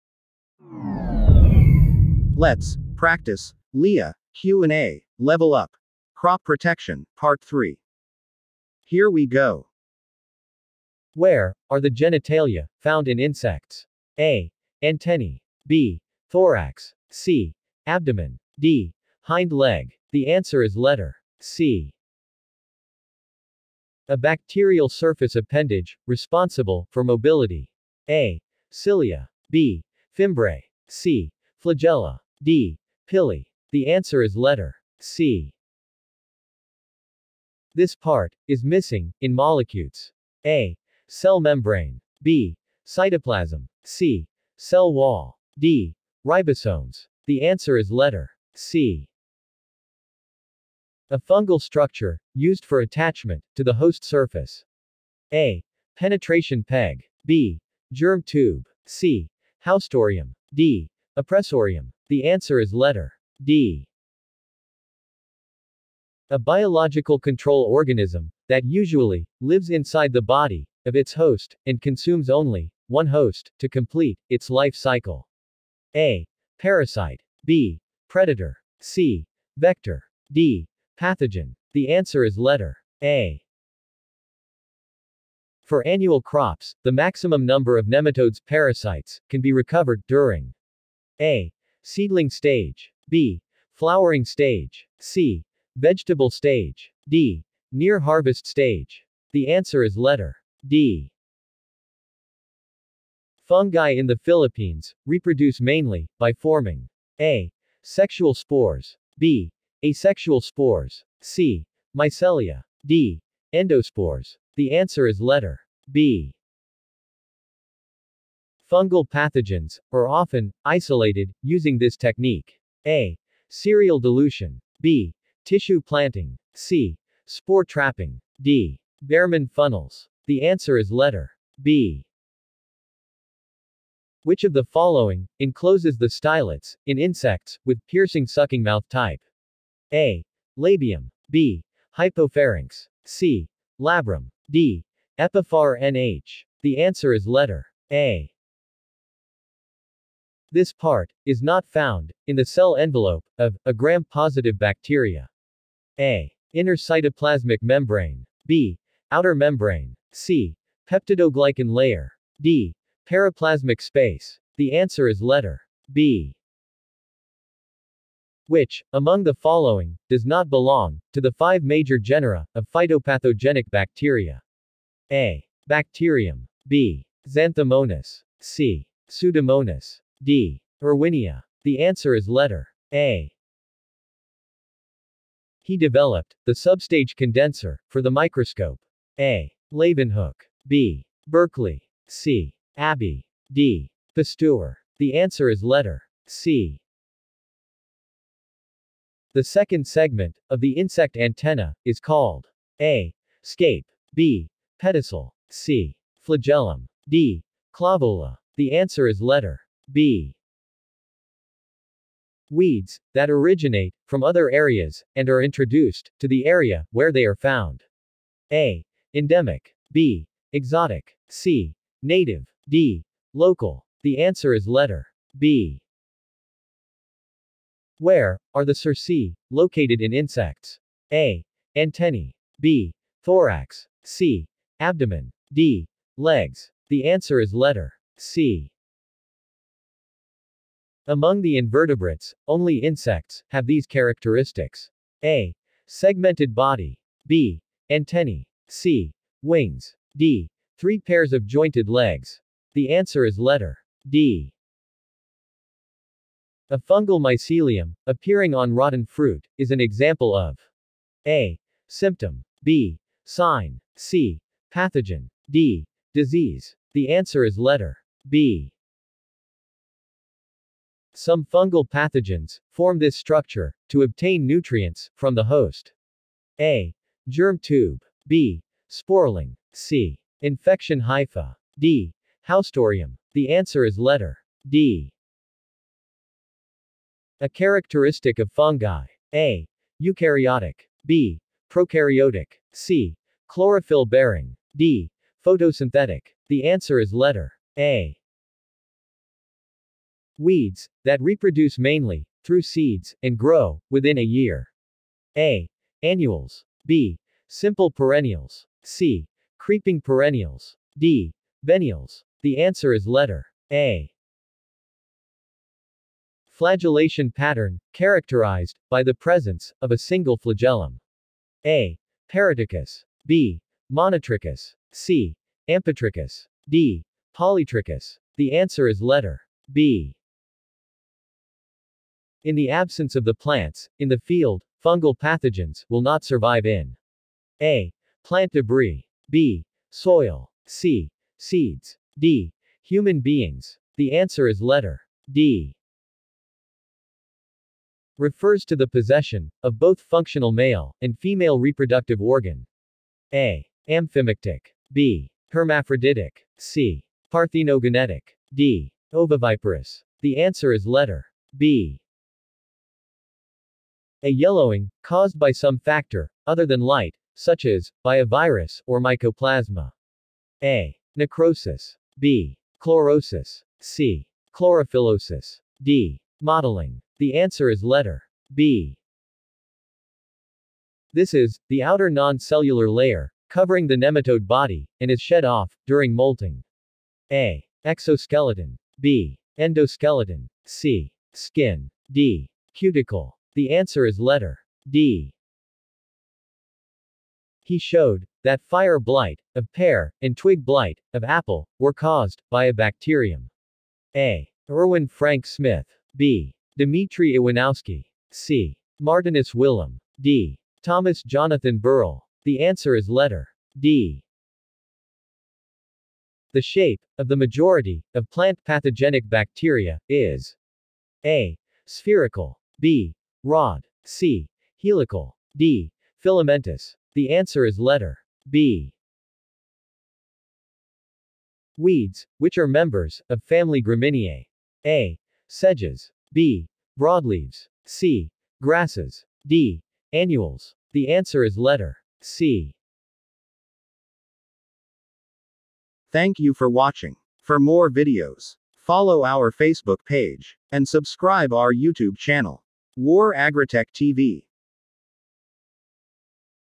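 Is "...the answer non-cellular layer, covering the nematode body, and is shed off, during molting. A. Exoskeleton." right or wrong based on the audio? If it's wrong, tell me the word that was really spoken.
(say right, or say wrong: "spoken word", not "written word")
wrong: "outer", not "answer".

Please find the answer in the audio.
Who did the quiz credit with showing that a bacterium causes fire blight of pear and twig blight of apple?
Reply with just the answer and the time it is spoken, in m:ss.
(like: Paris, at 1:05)
Thomas Jonathan Burrill, at 6:50.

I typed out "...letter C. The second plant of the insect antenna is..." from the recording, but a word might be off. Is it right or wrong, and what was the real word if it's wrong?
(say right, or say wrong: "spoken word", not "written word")
wrong: "segment", not "plant".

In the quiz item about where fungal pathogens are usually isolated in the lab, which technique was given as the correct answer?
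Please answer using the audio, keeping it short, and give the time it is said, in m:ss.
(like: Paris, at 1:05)
Tissue planting, at 2:05.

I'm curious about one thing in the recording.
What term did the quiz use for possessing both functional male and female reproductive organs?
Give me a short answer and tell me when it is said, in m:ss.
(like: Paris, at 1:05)
Hermaphroditic, at 5:55.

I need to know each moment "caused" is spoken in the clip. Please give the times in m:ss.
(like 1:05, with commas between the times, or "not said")
6:05, 6:41.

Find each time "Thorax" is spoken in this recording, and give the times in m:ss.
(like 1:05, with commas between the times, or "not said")
0:16, 3:53.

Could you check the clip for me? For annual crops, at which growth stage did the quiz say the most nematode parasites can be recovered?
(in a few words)
Near harvest stage.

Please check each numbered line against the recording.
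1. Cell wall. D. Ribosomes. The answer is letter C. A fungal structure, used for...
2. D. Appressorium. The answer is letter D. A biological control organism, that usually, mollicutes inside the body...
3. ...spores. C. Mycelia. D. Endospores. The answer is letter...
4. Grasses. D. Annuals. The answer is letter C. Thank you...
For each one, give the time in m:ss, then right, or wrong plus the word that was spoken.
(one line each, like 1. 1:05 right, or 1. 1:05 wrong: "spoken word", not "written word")
1. 0:44 right
2. 1:00 wrong: "lives", not "mollicutes"
3. 1:50 right
4. 7:18 right.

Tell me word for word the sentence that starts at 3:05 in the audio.
He developed the substage condenser for the microscope.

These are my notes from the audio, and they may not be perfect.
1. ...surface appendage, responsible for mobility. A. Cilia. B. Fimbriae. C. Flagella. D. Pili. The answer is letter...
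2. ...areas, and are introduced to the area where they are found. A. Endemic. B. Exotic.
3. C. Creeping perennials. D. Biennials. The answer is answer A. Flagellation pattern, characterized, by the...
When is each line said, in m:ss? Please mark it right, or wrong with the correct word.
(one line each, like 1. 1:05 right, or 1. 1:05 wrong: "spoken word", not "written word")
1. 0:24 right
2. 3:34 right
3. 5:08 wrong: "letter", not "answer".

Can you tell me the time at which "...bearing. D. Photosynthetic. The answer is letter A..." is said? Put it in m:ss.
4:54.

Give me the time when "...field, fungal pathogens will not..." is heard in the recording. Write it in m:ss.
5:34.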